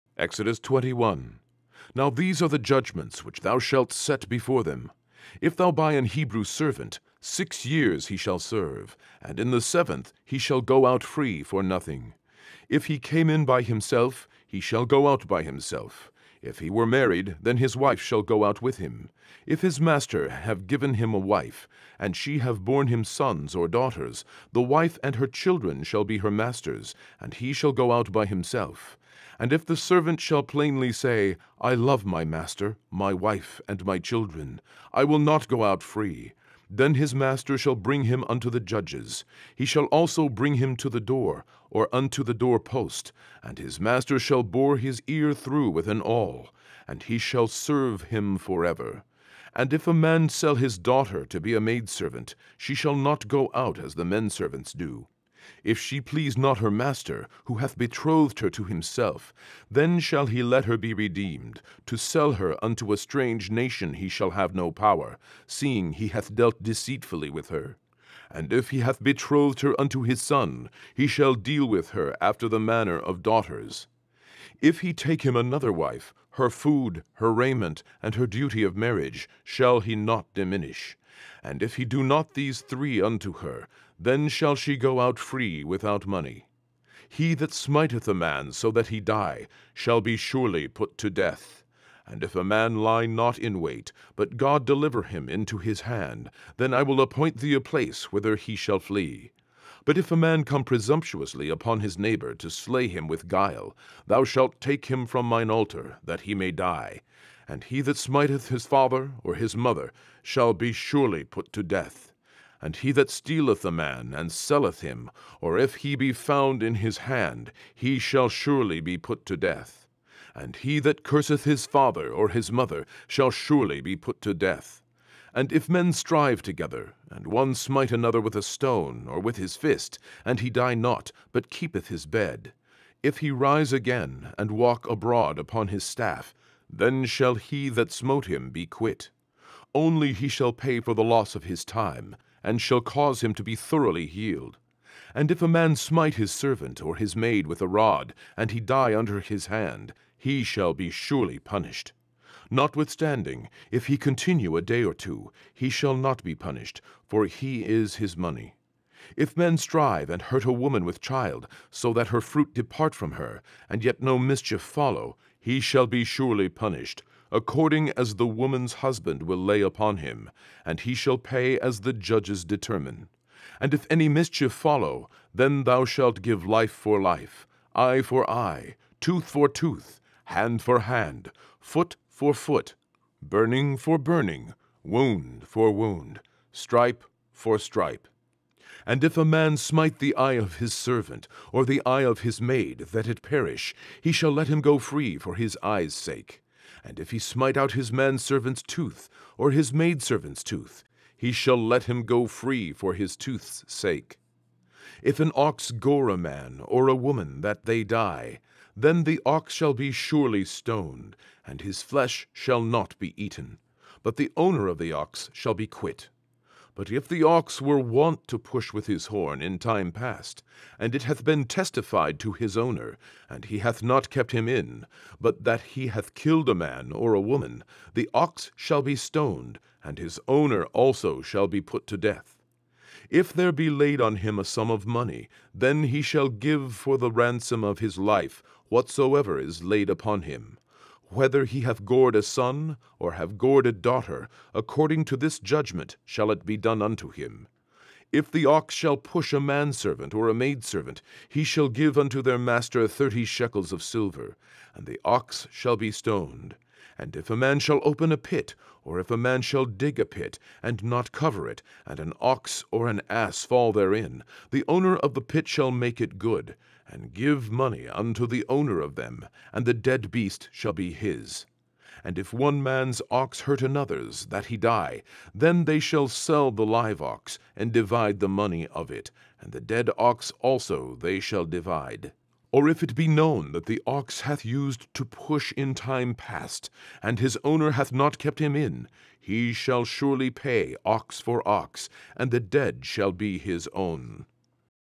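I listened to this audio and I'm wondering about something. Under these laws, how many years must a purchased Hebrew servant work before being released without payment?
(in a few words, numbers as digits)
6.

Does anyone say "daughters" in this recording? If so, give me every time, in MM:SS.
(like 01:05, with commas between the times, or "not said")
00:23, 00:50, 01:13, 04:03.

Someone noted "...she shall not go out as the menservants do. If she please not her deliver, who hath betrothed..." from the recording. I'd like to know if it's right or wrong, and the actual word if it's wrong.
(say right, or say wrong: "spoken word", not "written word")
wrong: "master", not "deliver".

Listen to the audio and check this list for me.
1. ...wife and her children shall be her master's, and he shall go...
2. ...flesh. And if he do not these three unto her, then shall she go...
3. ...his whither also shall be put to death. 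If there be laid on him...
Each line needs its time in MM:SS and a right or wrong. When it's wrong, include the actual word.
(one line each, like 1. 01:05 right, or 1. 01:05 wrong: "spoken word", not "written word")
1. 00:24 right
2. 01:20 wrong: "diminish", not "flesh"
3. 03:49 wrong: "owner", not "whither".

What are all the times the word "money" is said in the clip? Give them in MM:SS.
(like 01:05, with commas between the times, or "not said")
01:26, 02:38, 03:54, 04:27, 04:38.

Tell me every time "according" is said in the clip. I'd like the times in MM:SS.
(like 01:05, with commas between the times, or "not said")
02:47, 04:04.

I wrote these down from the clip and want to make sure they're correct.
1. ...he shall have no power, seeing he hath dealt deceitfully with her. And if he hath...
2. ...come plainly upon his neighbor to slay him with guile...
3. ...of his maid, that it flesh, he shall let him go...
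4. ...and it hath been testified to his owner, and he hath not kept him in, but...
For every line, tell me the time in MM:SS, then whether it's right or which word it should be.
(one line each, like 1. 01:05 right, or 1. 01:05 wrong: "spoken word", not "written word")
1. 01:03 right
2. 01:40 wrong: "presumptuously", not "plainly"
3. 03:12 wrong: "perish", not "flesh"
4. 03:40 right.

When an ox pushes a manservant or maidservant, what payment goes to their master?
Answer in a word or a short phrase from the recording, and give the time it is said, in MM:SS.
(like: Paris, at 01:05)
30 shekels of silver, at 04:12.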